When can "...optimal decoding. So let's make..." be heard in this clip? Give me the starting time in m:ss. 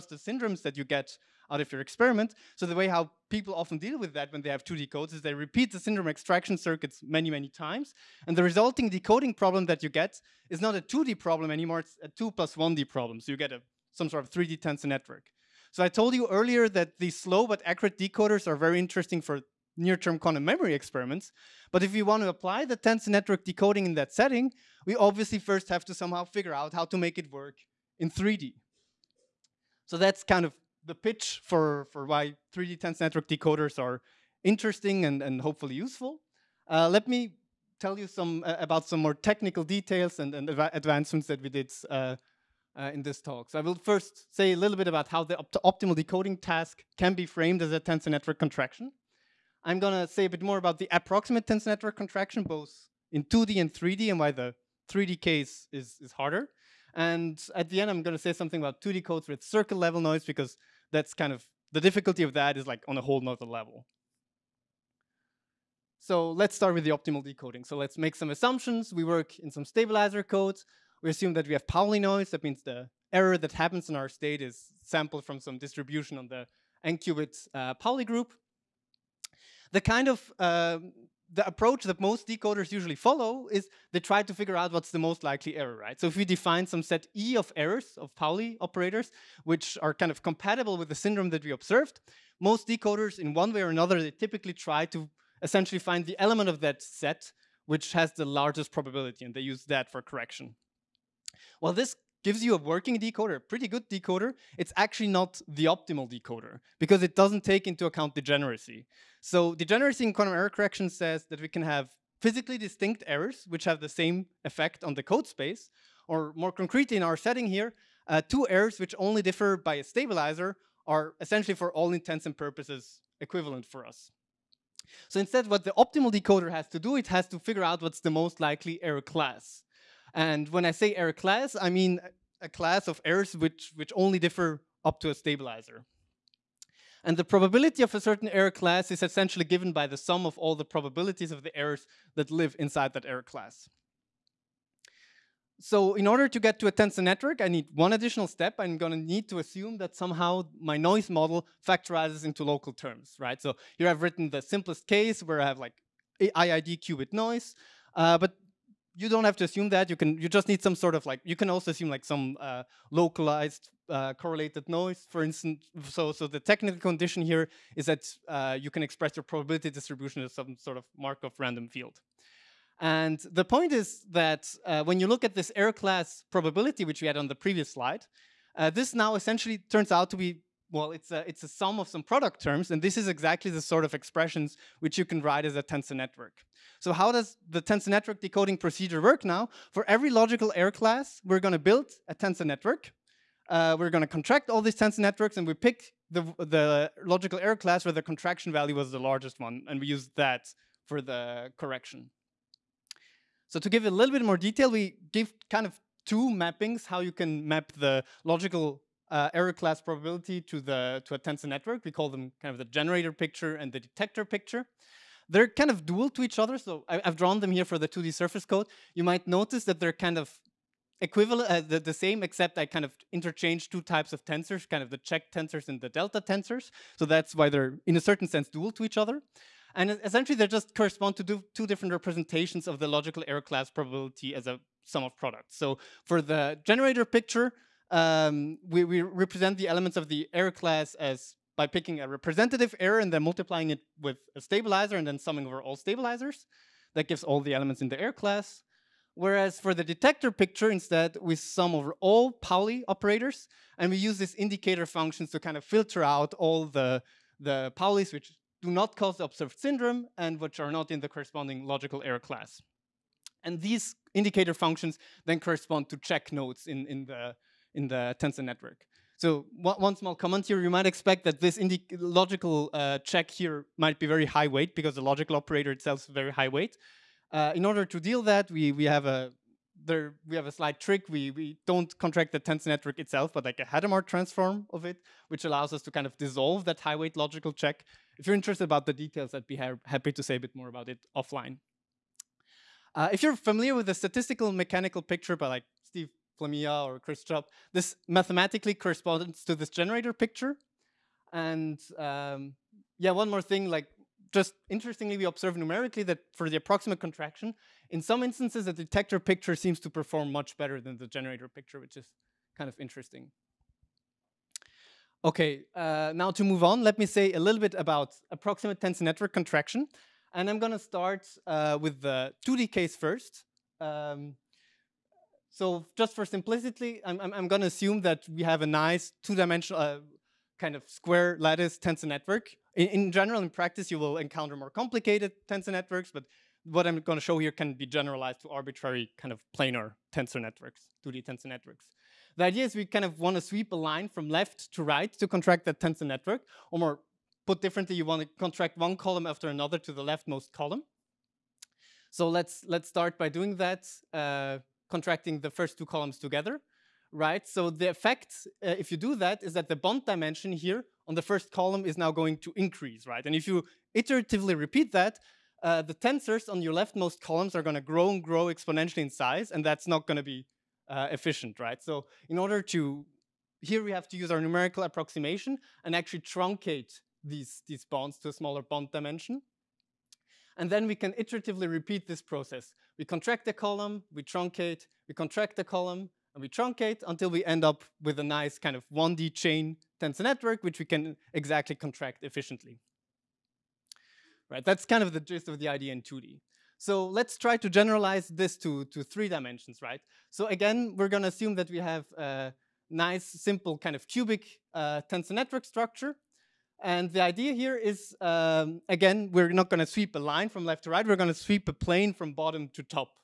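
1:06.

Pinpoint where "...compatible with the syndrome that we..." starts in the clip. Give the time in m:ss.
1:30.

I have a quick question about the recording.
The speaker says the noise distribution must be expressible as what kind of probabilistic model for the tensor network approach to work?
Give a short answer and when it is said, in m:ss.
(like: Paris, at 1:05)
Markov random field, at 2:50.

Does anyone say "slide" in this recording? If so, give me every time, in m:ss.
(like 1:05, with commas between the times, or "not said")
2:57.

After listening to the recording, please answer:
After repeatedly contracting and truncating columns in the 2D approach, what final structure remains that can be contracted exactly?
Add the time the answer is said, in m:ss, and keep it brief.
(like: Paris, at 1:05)
1D chain, at 6:28.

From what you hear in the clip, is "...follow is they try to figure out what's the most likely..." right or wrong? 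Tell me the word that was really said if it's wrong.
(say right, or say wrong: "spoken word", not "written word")
right.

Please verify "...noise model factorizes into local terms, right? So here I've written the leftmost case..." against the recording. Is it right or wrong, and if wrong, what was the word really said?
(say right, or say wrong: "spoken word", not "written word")
wrong: "simplest", not "leftmost".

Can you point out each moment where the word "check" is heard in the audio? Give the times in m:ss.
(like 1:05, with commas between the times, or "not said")
3:44, 4:25, 4:32, 4:47.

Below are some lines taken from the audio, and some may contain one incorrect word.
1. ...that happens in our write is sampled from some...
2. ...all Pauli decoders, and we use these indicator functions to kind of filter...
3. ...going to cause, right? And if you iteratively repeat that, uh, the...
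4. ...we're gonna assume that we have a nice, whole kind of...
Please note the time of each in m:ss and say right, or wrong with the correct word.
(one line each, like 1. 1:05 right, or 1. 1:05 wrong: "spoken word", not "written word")
1. 1:13 wrong: "state", not "write"
2. 4:12 wrong: "operators", not "decoders"
3. 6:02 wrong: "increase", not "cause"
4. 6:40 wrong: "simple", not "whole".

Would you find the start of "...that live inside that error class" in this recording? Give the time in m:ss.
2:22.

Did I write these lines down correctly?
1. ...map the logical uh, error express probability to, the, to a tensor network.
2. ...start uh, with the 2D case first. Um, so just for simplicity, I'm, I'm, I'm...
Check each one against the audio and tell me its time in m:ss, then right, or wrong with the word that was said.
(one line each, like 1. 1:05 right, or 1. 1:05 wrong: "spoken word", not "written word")
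1. 3:27 wrong: "class", not "express"
2. 5:20 right.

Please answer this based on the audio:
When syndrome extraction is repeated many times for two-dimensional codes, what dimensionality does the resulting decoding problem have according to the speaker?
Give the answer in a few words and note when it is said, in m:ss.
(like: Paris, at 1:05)
2 plus 1D, at 0:12.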